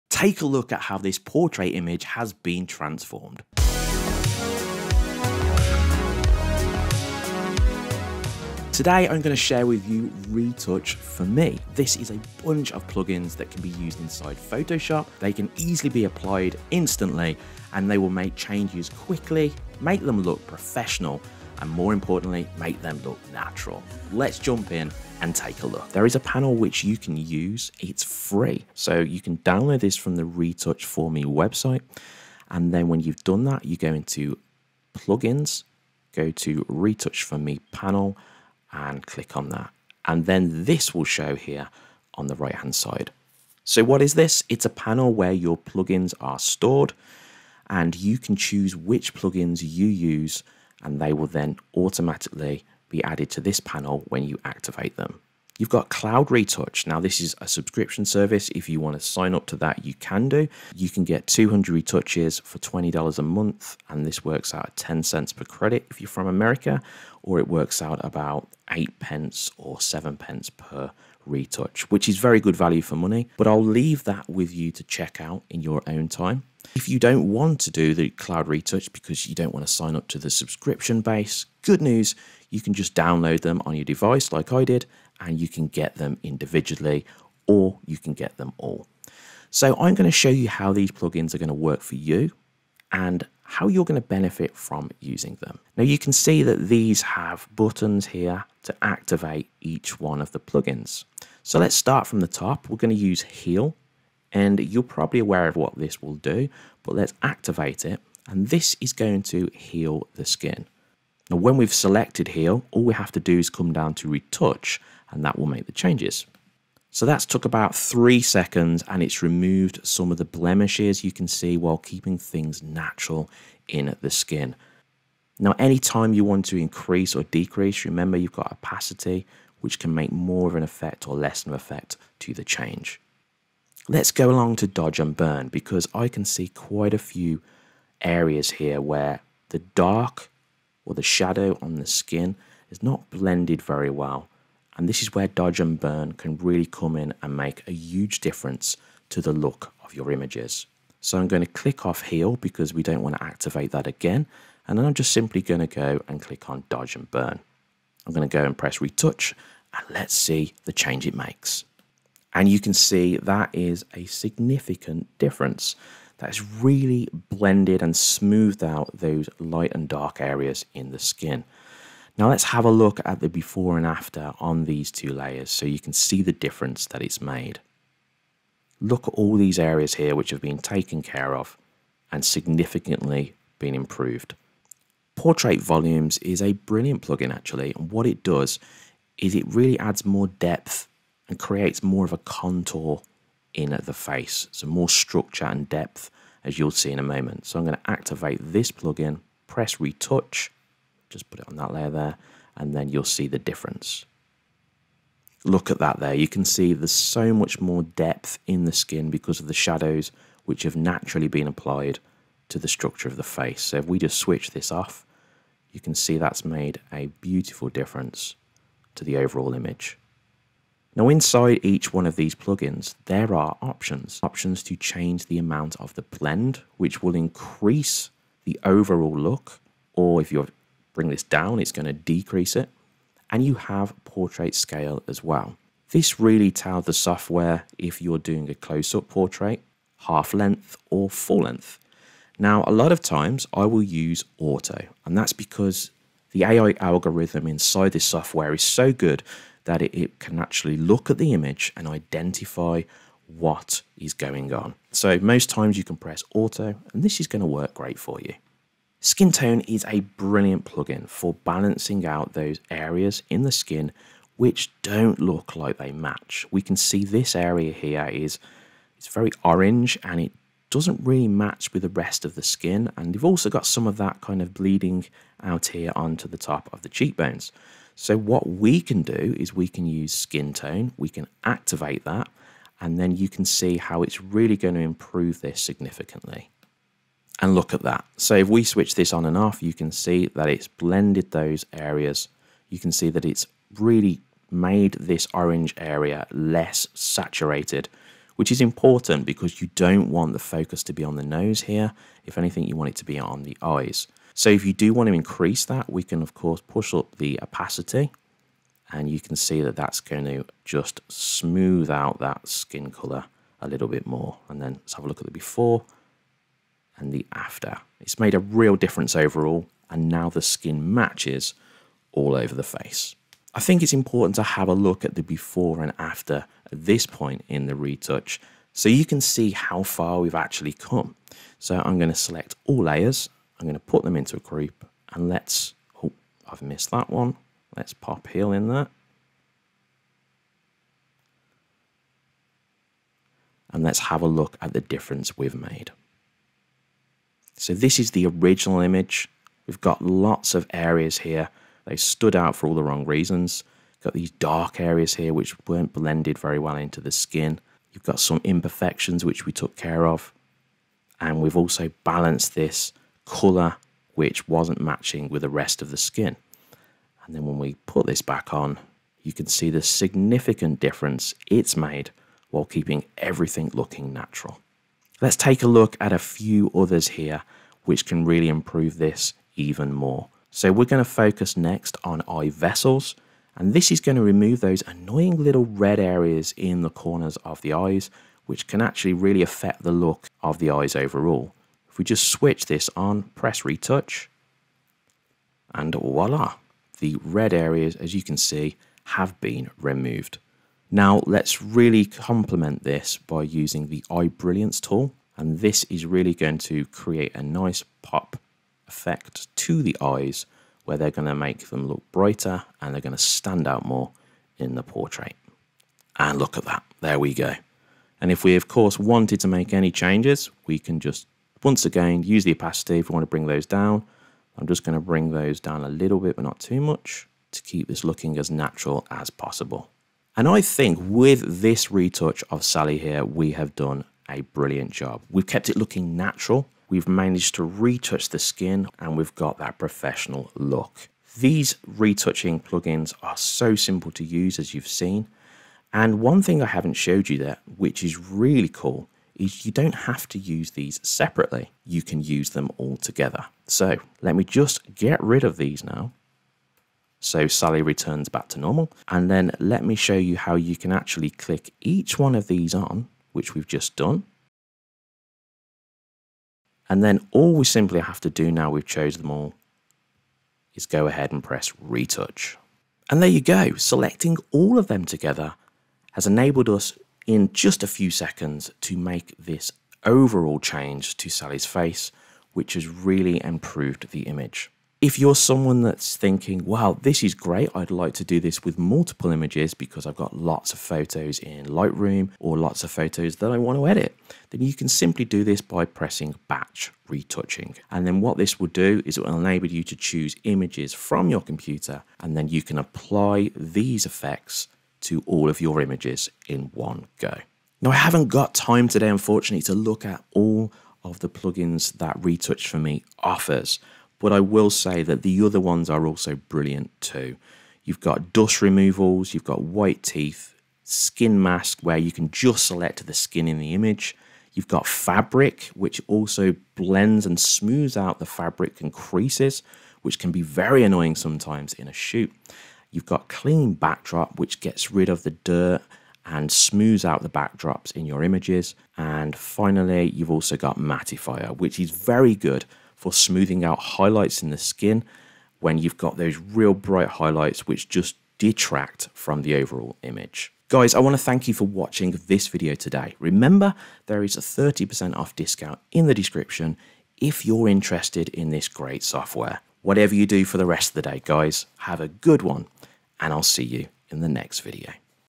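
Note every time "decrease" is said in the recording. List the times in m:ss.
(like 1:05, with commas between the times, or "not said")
2:07, 3:51.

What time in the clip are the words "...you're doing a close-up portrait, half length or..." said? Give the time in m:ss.
3:58.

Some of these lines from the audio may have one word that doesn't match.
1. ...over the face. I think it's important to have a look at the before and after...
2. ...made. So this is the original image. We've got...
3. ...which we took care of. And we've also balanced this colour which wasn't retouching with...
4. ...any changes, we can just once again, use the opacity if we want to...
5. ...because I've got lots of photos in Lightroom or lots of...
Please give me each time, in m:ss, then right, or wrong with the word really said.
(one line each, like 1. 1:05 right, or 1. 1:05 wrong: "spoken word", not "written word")
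1. 5:22 right
2. 5:45 right
3. 5:59 wrong: "matching", not "retouching"
4. 6:59 right
5. 8:09 right.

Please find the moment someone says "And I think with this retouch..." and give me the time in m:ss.
7:10.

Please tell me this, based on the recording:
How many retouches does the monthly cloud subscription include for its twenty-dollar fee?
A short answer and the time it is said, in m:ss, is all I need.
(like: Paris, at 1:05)
200, at 1:01.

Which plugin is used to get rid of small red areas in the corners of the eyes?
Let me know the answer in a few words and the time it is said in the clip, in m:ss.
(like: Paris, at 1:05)
Eye Vessels, at 6:22.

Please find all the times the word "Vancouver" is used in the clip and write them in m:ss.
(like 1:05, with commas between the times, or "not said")
not said.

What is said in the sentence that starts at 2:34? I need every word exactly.
And then I'm just simply going to go and click on dodge and burn.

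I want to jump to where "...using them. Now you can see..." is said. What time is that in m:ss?
1:34.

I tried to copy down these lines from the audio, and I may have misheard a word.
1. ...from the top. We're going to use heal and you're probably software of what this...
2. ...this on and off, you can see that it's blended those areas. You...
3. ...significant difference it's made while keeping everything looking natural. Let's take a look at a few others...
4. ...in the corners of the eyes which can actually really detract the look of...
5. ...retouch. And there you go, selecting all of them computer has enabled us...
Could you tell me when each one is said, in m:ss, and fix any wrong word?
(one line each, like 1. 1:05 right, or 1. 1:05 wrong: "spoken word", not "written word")
1. 1:42 wrong: "aware", not "software"
2. 4:48 right
3. 6:09 right
4. 6:26 wrong: "affect", not "detract"
5. 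7:51 wrong: "together", not "computer".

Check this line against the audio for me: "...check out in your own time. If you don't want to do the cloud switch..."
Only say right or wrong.
wrong.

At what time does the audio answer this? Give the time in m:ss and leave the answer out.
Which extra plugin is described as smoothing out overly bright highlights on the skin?
9:00.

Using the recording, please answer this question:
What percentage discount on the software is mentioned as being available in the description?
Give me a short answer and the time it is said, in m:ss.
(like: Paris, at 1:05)
30%, at 9:14.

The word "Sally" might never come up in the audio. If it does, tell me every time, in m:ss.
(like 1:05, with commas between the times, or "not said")
7:12, 7:37, 8:01.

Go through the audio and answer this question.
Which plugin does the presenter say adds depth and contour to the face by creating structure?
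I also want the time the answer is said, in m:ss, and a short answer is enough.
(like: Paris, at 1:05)
Portrait Volumes, at 3:05.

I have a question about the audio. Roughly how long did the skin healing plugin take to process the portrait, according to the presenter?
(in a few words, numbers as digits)
3 seconds.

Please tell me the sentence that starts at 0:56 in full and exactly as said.
Now, this is a subscription service.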